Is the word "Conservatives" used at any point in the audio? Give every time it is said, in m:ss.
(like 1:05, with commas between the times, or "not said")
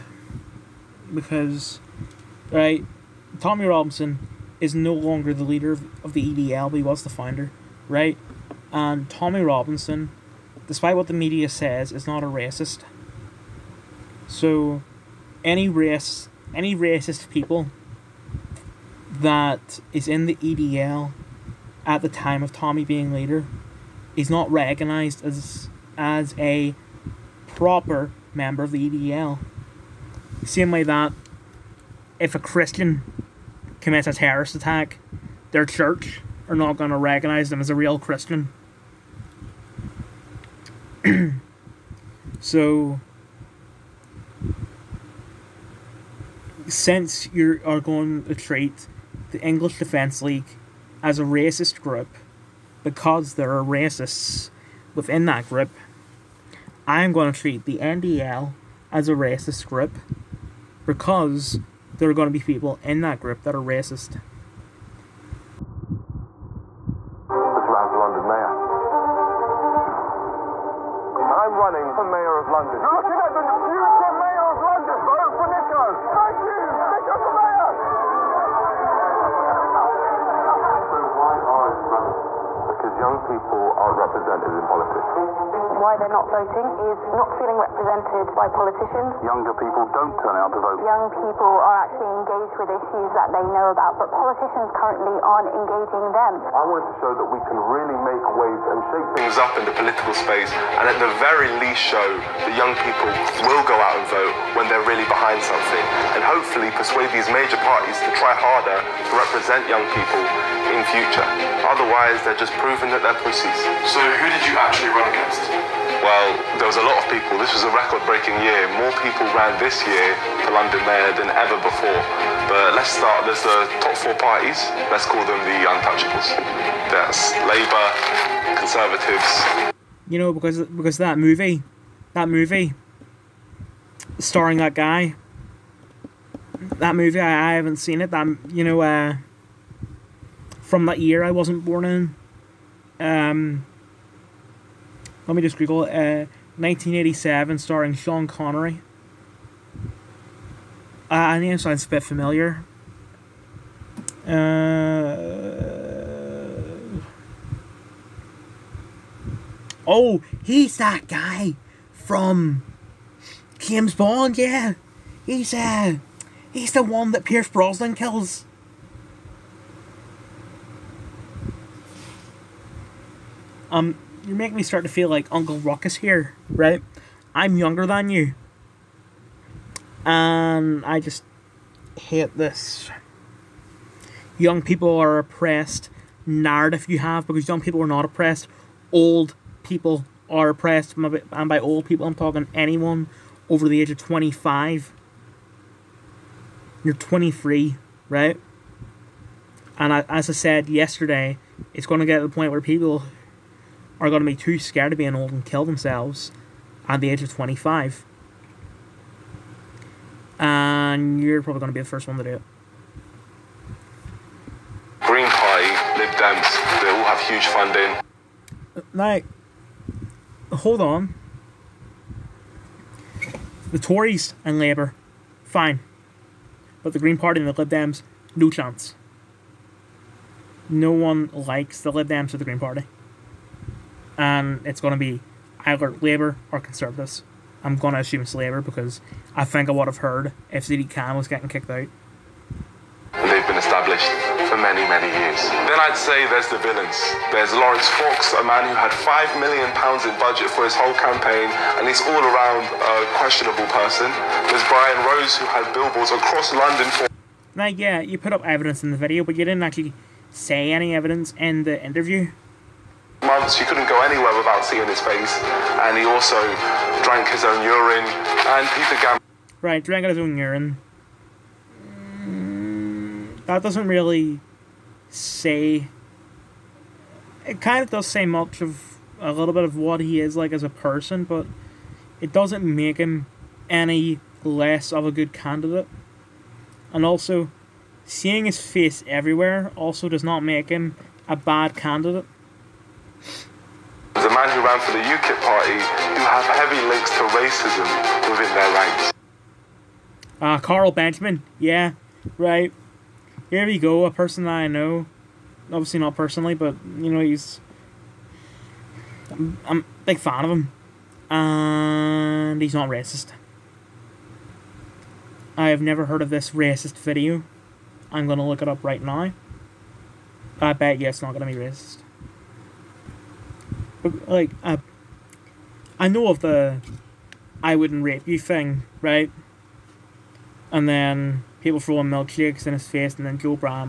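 2:08, 3:56.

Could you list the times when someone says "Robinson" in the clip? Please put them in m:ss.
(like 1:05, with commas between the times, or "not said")
0:03, 0:09.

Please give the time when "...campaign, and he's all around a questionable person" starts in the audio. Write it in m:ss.
4:10.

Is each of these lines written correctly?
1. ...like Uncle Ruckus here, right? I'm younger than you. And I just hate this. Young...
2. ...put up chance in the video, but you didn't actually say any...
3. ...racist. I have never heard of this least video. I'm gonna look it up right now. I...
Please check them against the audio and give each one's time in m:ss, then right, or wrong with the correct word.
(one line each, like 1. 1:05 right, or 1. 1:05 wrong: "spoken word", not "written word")
1. 2:55 right
2. 4:18 wrong: "evidence", not "chance"
3. 5:12 wrong: "racist", not "least".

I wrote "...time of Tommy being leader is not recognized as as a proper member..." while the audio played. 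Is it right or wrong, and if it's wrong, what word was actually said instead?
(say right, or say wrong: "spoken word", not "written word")
right.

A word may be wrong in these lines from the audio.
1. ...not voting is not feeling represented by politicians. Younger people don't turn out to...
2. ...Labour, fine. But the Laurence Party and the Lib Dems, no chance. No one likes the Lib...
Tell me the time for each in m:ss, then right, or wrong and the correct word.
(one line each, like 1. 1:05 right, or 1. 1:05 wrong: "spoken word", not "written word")
1. 1:26 right
2. 3:44 wrong: "Green", not "Laurence".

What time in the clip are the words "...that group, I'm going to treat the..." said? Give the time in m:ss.
0:55.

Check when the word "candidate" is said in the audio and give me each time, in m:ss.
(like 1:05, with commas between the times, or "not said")
4:45, 4:51.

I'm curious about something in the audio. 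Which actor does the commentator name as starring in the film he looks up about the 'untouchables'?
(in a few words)
Sean Connery.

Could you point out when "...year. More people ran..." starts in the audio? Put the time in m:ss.
1:58.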